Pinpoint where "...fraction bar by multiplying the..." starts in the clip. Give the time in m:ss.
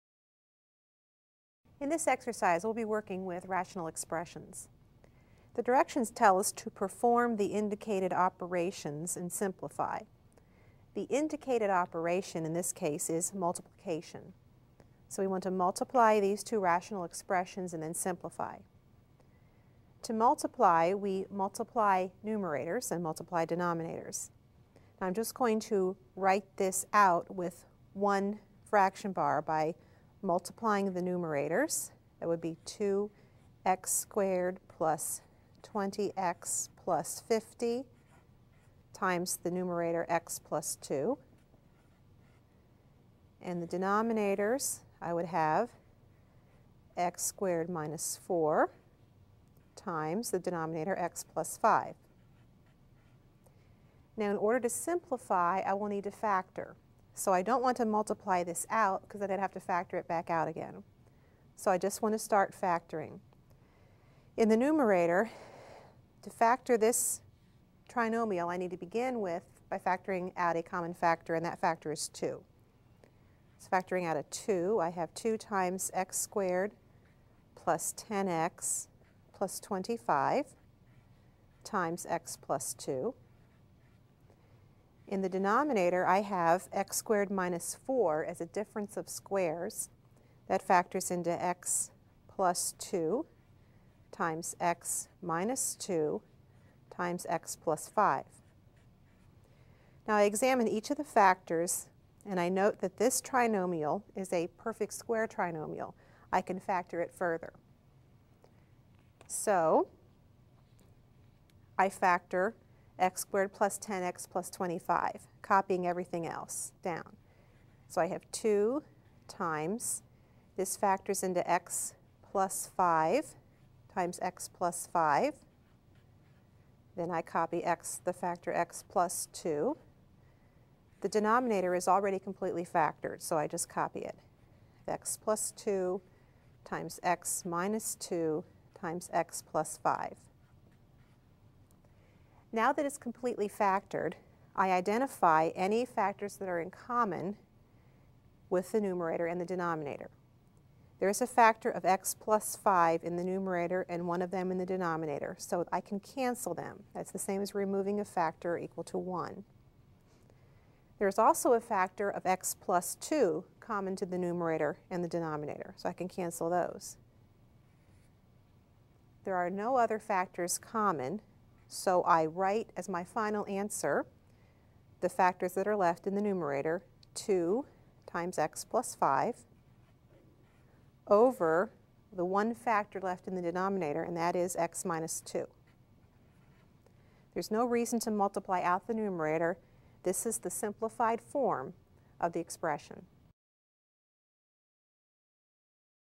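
0:28.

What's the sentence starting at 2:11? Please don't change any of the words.
The denominator is already completely factored, so I just copy it.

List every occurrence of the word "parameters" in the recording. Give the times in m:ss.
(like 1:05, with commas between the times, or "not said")
not said.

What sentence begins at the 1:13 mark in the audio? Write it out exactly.
So factoring out a 2, I have 2 times x squared plus 10x plus 25 times x plus 2.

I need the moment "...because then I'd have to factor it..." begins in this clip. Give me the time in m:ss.
0:59.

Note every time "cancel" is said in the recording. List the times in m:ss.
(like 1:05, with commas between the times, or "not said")
2:36, 2:46.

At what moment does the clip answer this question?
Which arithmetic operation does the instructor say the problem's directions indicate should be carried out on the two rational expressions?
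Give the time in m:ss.
0:13.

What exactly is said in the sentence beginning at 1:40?
Now I examine each of the factors and I note that this trinomial is a perfect square trinomial.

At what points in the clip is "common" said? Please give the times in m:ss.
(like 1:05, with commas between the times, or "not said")
1:10, 2:26, 2:43, 2:50.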